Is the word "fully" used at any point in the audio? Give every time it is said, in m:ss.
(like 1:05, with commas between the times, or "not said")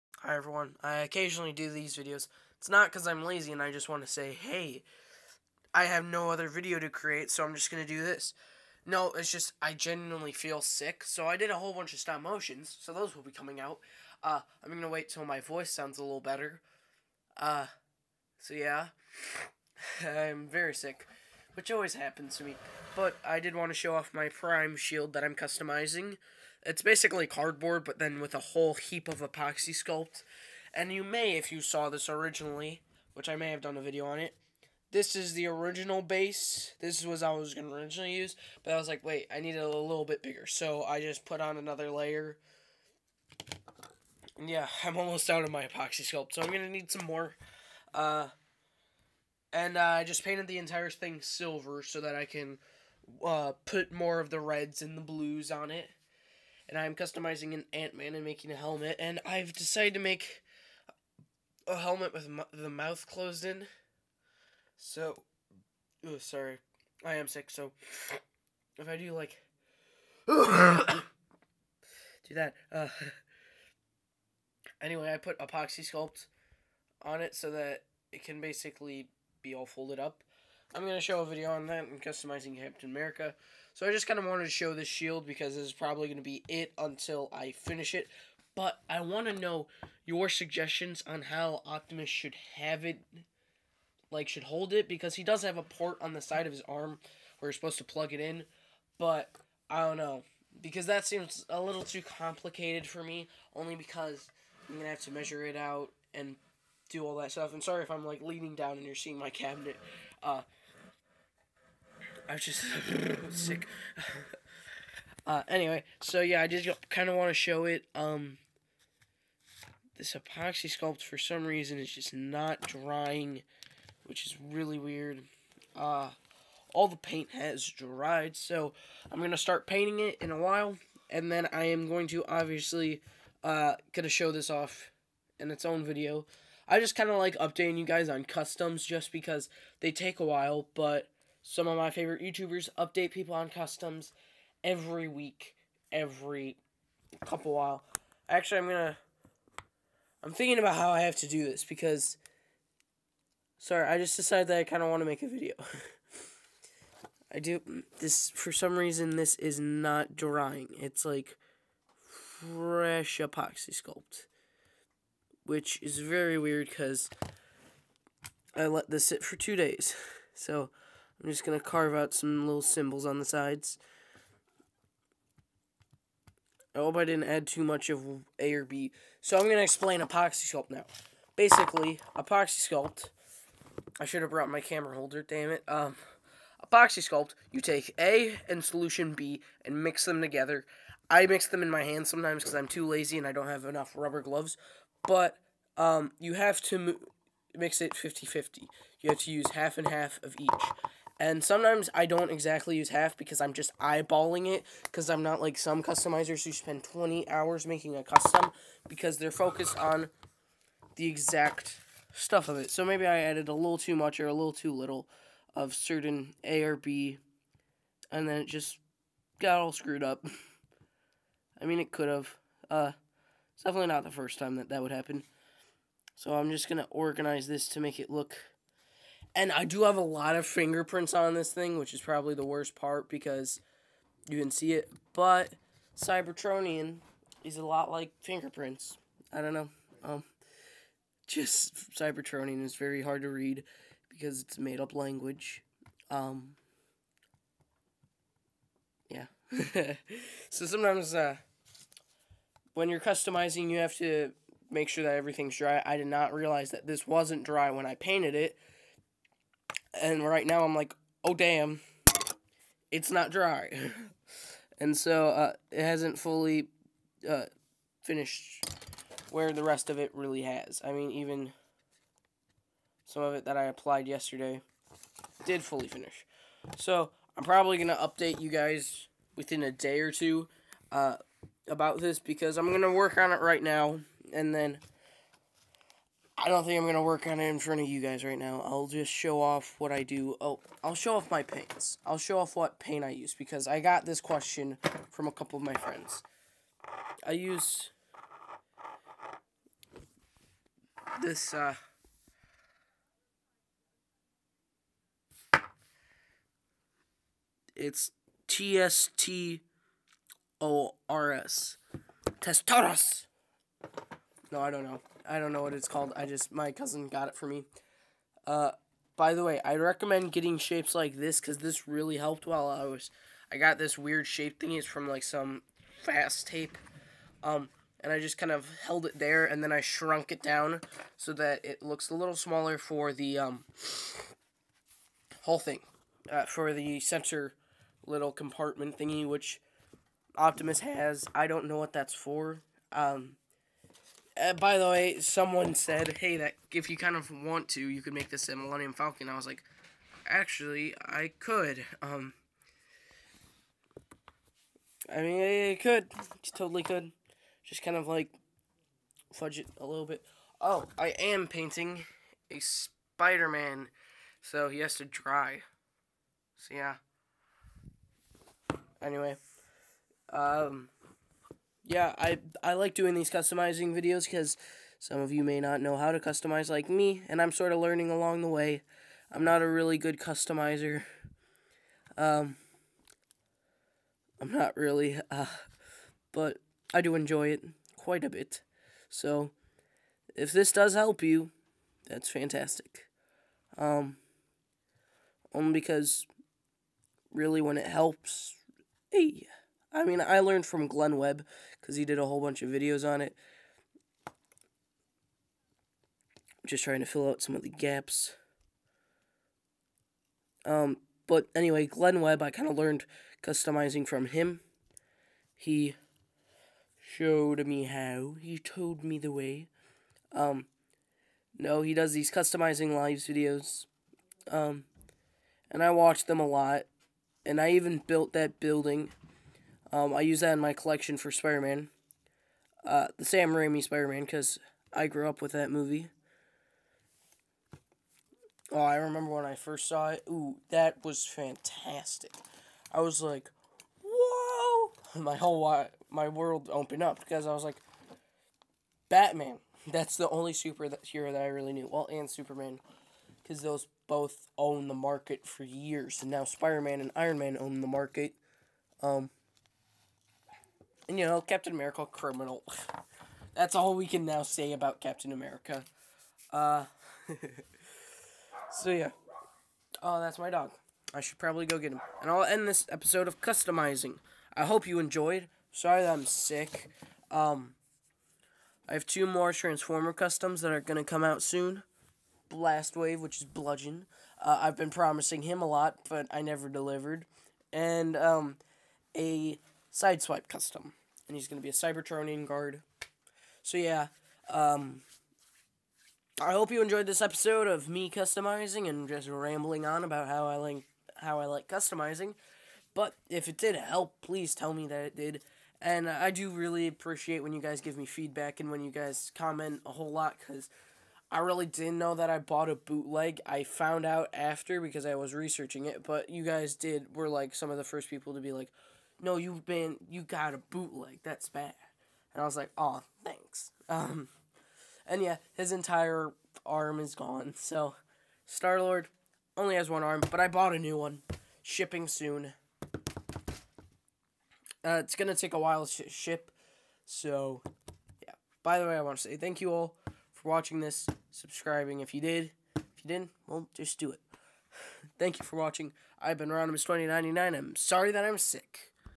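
4:26, 4:35.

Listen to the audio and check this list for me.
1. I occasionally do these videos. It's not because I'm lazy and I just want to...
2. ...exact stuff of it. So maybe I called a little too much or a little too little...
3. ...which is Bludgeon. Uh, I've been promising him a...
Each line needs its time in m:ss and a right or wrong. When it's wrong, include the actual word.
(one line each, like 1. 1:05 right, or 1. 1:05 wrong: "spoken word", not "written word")
1. 0:00 right
2. 3:31 wrong: "added", not "called"
3. 8:03 right.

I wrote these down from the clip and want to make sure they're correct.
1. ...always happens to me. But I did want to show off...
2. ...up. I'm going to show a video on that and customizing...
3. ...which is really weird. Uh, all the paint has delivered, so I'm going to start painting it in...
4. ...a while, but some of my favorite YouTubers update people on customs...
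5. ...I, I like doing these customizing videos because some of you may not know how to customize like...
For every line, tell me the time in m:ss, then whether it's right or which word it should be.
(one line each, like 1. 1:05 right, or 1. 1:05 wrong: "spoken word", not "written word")
1. 0:21 right
2. 1:19 right
3. 2:04 wrong: "dried", not "delivered"
4. 2:20 right
5. 6:12 right.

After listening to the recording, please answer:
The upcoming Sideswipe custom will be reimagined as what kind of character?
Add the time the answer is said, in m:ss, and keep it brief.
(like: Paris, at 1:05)
Cybertronian guard, at 8:11.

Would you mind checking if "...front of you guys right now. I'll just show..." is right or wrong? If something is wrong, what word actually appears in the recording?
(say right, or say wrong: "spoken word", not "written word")
right.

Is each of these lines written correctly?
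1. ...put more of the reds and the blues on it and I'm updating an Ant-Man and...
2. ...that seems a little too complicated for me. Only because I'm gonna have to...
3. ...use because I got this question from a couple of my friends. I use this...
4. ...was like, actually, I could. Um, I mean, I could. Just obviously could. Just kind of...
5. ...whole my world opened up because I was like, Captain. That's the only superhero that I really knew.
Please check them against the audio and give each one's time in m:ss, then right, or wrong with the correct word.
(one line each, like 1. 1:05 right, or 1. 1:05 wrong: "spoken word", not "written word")
1. 0:53 wrong: "customizing", not "updating"
2. 1:40 right
3. 4:53 right
4. 5:49 wrong: "totally", not "obviously"
5. 7:25 wrong: "Batman", not "Captain".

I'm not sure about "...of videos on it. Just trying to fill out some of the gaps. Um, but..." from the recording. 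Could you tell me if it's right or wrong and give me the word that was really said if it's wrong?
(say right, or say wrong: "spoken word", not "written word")
right.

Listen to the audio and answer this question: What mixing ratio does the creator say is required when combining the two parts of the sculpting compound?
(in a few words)
50-50.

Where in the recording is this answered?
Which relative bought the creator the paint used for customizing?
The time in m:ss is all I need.
5:16.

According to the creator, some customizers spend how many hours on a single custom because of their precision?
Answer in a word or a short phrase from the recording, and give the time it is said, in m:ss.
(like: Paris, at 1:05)
20 hours, at 3:26.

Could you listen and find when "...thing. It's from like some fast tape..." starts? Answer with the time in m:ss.
5:24.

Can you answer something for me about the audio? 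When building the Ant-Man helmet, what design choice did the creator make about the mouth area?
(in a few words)
Mouth closed in.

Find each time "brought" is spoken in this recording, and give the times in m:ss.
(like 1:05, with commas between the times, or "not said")
3:04.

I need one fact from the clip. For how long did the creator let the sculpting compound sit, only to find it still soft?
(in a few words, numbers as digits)
2 days.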